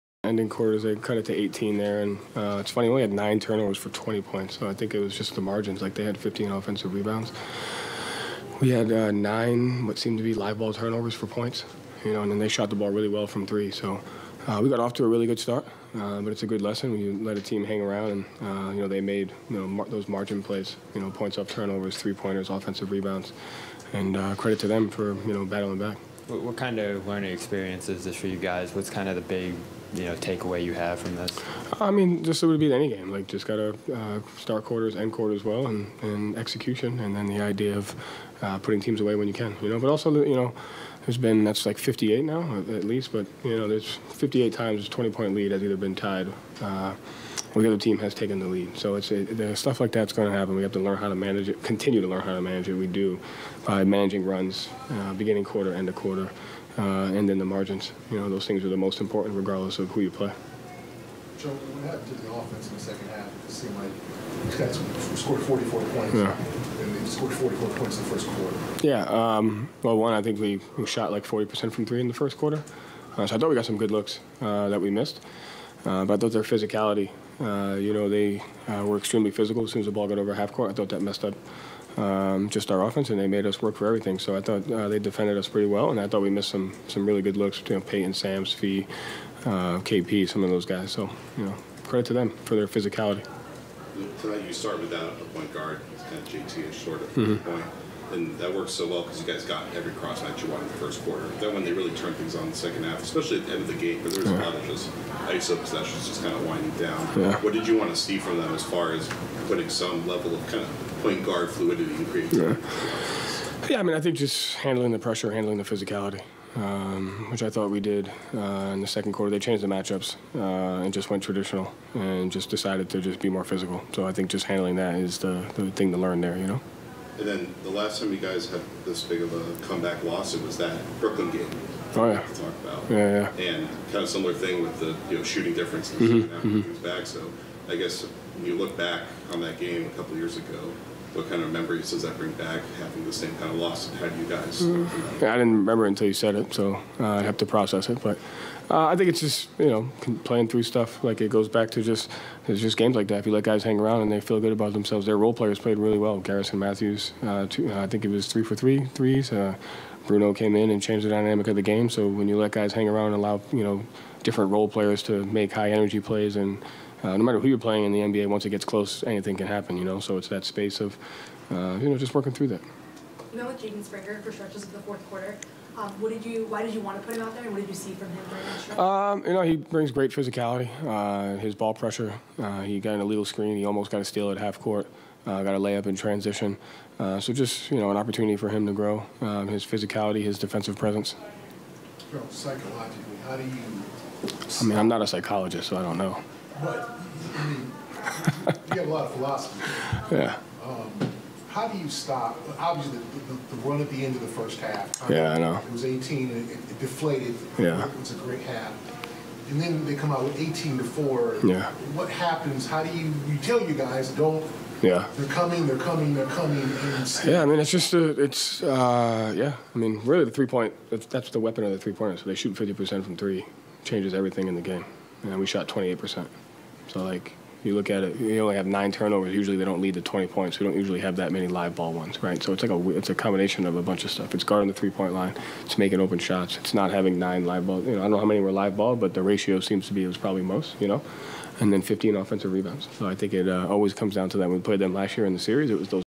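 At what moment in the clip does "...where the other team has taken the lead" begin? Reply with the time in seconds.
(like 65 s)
47 s.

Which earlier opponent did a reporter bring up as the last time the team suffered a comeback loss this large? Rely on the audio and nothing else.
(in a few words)
Brooklyn.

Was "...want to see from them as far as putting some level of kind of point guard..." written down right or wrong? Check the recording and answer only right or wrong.
right.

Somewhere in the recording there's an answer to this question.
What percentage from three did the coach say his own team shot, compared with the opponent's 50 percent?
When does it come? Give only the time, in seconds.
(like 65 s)
225 s.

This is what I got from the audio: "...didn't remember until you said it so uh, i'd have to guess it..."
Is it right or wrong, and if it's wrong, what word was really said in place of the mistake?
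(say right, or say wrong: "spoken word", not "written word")
wrong: "process", not "guess".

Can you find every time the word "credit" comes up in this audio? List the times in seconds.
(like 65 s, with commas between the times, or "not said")
24 s, 91 s.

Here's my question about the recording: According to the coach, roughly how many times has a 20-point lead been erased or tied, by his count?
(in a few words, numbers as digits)
58.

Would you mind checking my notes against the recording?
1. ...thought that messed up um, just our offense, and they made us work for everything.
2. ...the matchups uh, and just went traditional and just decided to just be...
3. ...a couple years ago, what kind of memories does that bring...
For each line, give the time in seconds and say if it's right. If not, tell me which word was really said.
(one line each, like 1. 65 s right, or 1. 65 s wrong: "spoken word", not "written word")
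1. 80 s right
2. 119 s right
3. 139 s right.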